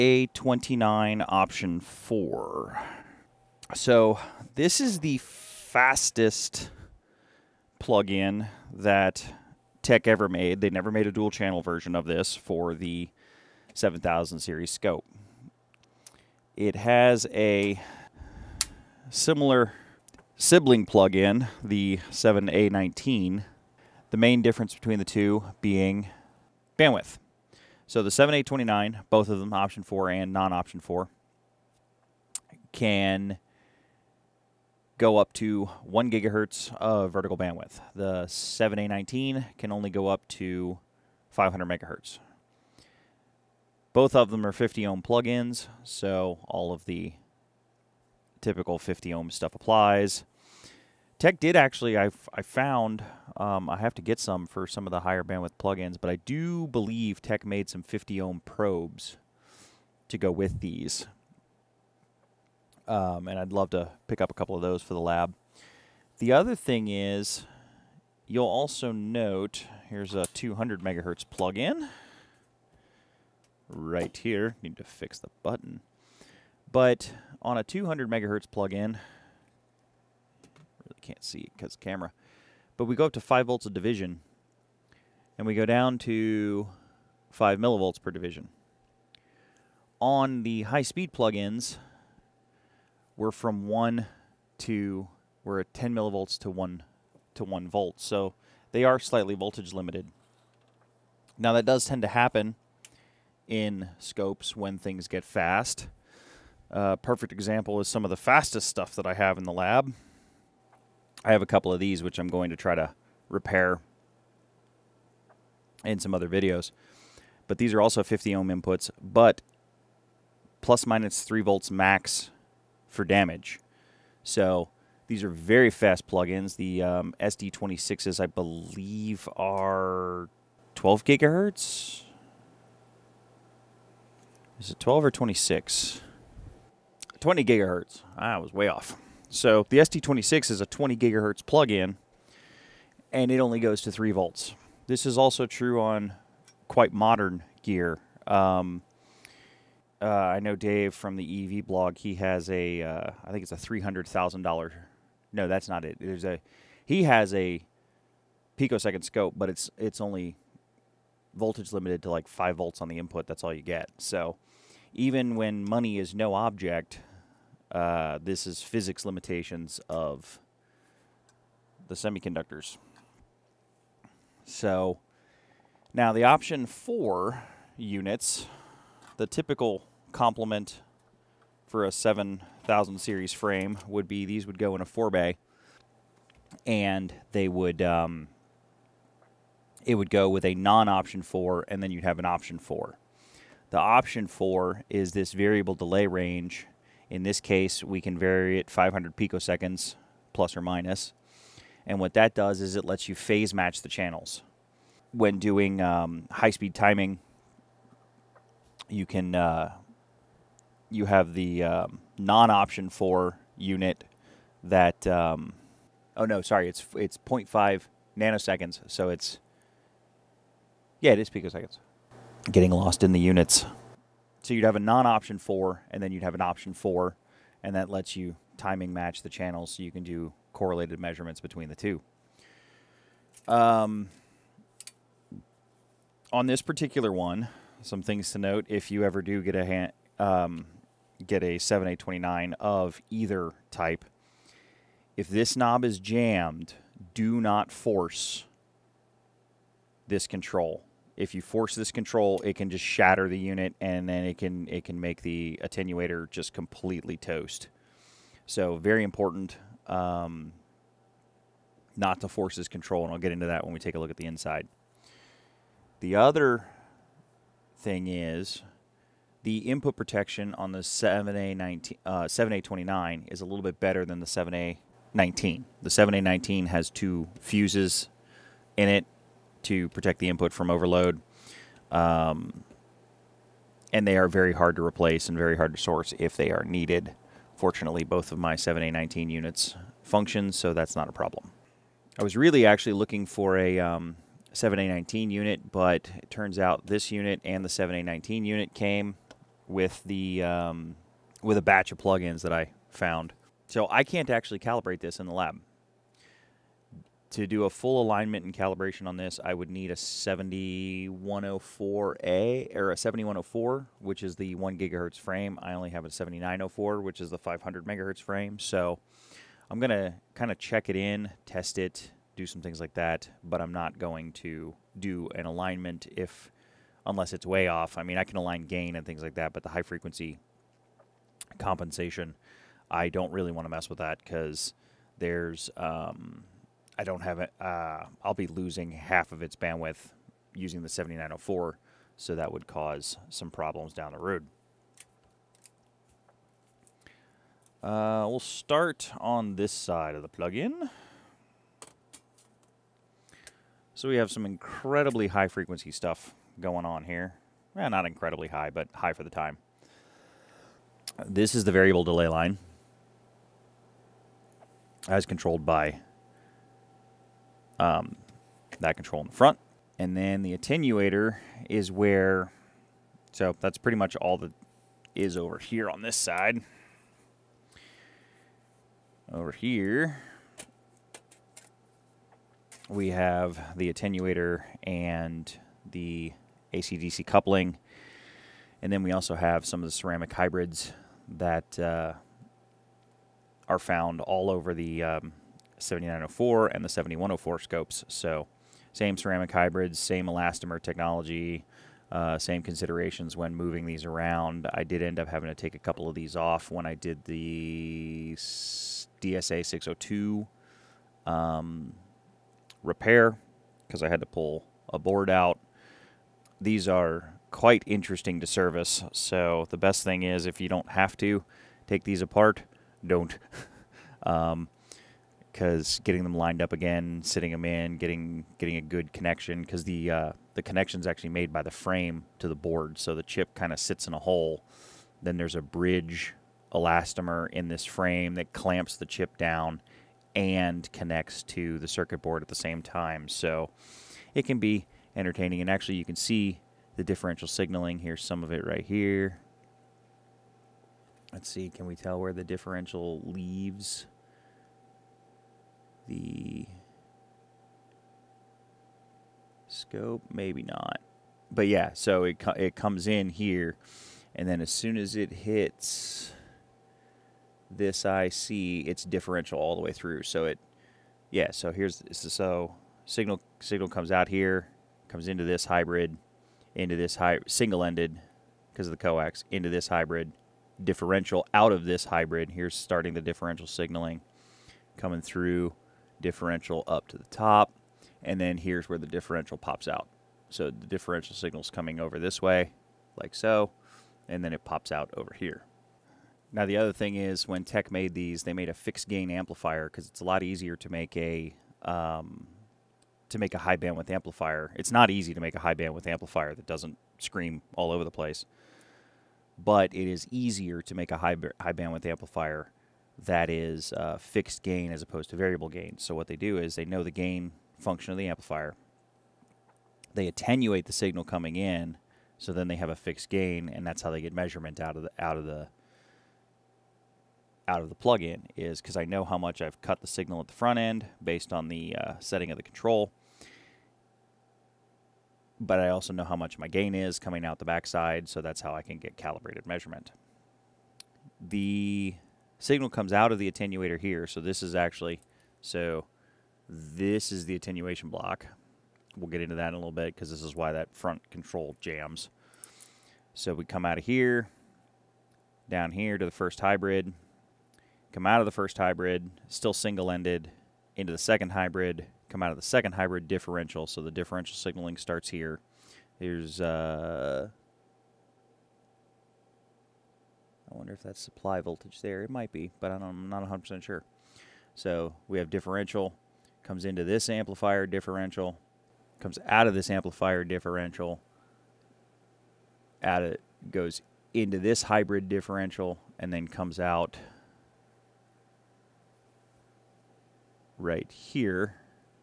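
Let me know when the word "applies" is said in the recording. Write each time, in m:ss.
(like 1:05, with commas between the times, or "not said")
0:49.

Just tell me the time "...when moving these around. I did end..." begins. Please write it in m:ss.
6:43.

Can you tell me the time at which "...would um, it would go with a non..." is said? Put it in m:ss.
3:07.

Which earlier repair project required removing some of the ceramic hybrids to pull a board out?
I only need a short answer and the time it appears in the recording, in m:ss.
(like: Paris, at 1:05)
DSA 602, at 6:48.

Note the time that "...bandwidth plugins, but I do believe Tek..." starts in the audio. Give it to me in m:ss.
0:55.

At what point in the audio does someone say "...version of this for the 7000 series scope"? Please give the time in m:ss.
0:11.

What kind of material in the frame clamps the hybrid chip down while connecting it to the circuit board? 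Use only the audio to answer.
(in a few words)
bridge elastomer.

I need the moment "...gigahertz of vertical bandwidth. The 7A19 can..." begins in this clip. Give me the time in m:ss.
0:36.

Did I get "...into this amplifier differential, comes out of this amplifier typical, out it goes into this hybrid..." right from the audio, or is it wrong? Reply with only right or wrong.
wrong.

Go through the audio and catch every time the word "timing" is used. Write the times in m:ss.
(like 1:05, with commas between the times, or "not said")
3:26, 3:48.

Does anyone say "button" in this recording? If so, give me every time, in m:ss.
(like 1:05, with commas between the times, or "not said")
1:15.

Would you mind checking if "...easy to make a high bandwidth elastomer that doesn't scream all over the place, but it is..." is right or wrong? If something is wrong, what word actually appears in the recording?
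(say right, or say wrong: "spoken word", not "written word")
wrong: "amplifier", not "elastomer".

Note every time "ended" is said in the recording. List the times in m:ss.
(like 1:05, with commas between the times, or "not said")
7:57, 9:19.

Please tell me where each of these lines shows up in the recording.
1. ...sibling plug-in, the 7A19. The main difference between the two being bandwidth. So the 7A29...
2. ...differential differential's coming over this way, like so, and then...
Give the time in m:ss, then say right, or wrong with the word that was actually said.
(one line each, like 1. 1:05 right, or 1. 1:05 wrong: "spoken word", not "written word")
1. 0:20 right
2. 8:10 wrong: "signal", not "differential".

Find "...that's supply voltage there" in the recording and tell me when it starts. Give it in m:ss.
9:31.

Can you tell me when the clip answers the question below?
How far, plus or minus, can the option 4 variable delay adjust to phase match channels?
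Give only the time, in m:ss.
3:37.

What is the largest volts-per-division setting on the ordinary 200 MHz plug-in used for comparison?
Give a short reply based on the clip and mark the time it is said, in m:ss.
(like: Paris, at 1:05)
5 volts a division, at 1:23.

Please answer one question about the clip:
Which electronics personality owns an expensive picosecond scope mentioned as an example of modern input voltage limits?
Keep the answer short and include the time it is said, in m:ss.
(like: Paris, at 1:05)
Dave from the EEVblog, at 2:30.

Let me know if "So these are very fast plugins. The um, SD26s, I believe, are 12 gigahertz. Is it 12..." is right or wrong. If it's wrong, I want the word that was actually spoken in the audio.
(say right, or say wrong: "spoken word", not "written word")
right.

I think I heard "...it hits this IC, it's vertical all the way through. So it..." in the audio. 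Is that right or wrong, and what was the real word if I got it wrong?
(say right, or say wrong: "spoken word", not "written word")
wrong: "differential", not "vertical".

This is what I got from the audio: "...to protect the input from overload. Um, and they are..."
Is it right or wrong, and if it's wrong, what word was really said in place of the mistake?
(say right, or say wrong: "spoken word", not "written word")
right.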